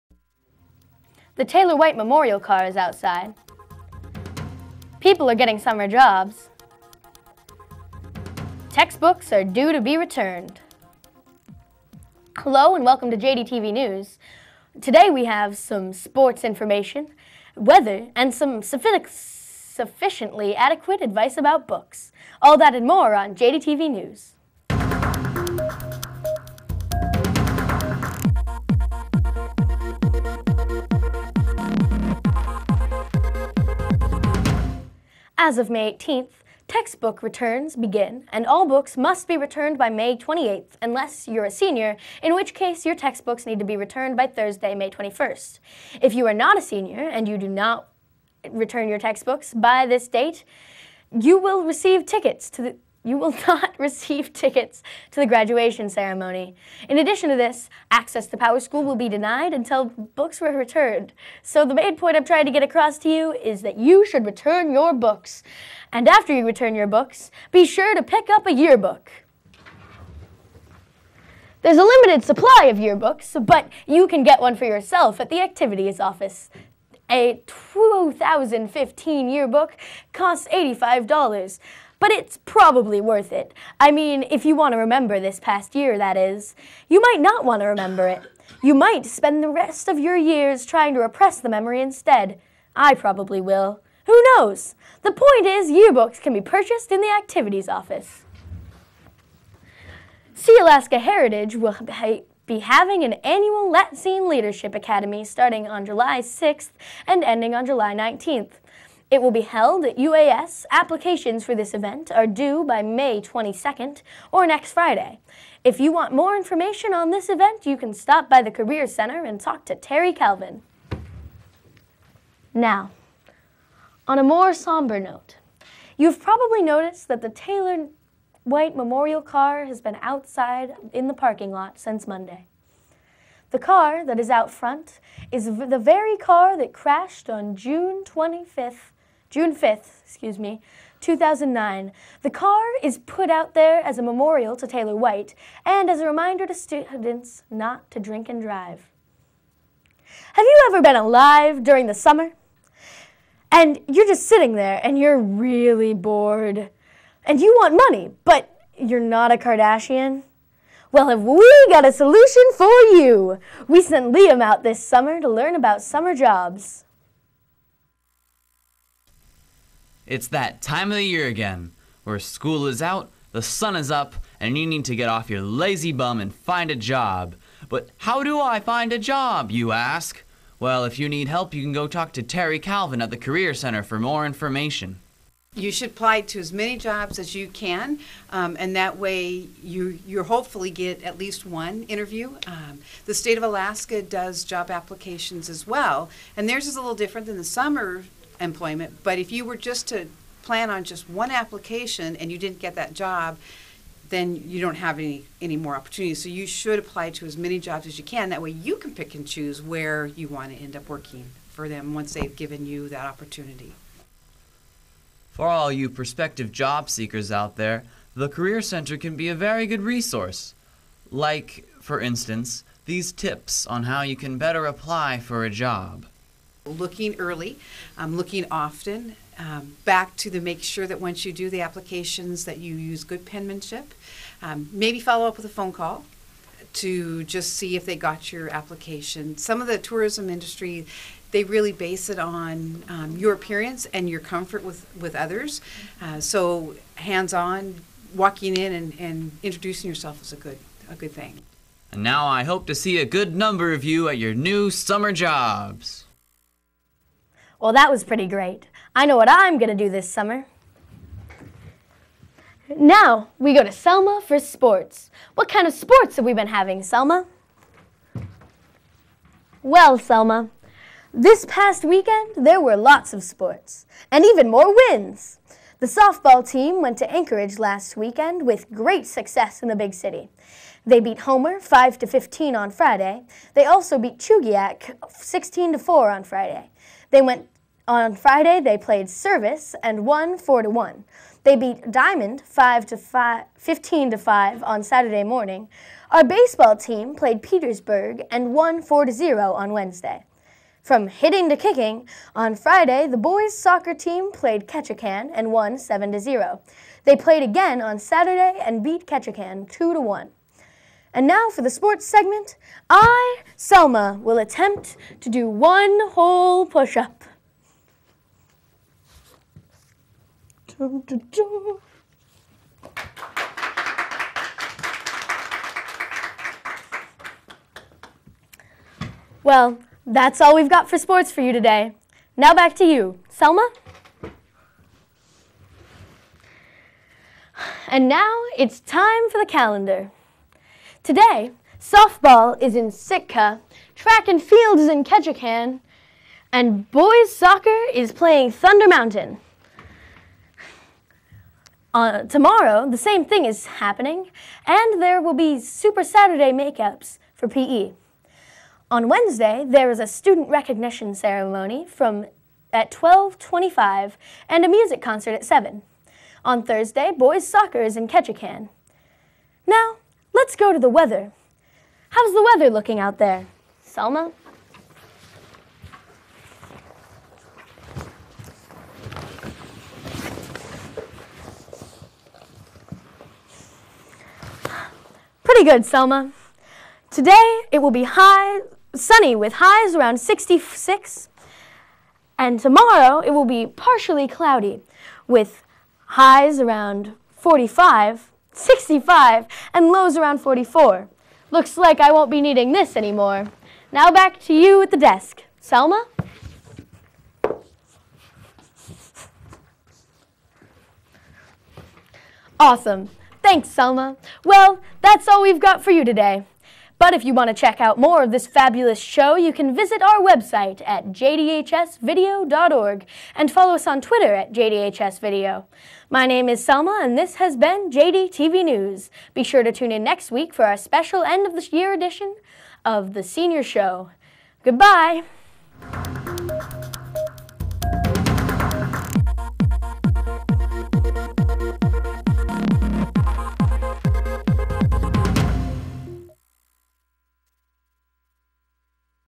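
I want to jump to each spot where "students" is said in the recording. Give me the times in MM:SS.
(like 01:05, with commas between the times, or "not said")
02:26, 06:00.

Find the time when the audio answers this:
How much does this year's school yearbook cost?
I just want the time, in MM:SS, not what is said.
01:20.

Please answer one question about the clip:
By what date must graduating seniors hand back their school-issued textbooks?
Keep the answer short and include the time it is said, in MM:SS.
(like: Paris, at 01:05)
May 21, at 00:44.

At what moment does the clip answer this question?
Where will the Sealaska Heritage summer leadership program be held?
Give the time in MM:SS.
01:49.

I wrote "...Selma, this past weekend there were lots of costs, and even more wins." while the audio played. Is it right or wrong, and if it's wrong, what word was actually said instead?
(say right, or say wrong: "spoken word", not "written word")
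wrong: "sports", not "costs".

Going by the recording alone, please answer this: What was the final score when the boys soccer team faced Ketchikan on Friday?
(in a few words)
7 to 0.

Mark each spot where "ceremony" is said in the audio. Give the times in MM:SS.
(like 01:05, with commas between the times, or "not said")
00:55, 06:01.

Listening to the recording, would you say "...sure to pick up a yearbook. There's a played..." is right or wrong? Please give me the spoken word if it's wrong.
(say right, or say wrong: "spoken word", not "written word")
wrong: "limited", not "played".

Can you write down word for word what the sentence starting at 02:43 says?
We sent Liam out this summer to learn about summer jobs.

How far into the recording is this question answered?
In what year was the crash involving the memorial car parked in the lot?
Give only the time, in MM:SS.
02:20.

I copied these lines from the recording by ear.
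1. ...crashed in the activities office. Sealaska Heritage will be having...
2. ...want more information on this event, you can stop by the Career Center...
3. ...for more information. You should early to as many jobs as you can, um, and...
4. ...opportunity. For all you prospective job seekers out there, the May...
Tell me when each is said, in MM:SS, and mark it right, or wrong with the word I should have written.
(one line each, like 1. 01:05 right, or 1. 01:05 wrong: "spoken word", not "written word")
1. 01:36 wrong: "purchased", not "crashed"
2. 01:55 right
3. 03:03 wrong: "apply", not "early"
4. 03:33 wrong: "Career", not "May".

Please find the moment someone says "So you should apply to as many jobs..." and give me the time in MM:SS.
03:26.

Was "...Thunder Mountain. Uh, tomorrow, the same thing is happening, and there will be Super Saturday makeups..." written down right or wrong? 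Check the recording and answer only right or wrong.
right.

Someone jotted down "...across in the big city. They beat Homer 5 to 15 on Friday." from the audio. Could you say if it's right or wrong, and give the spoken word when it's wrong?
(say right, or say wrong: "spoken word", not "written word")
wrong: "success", not "across".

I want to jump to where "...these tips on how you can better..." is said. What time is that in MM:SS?
03:42.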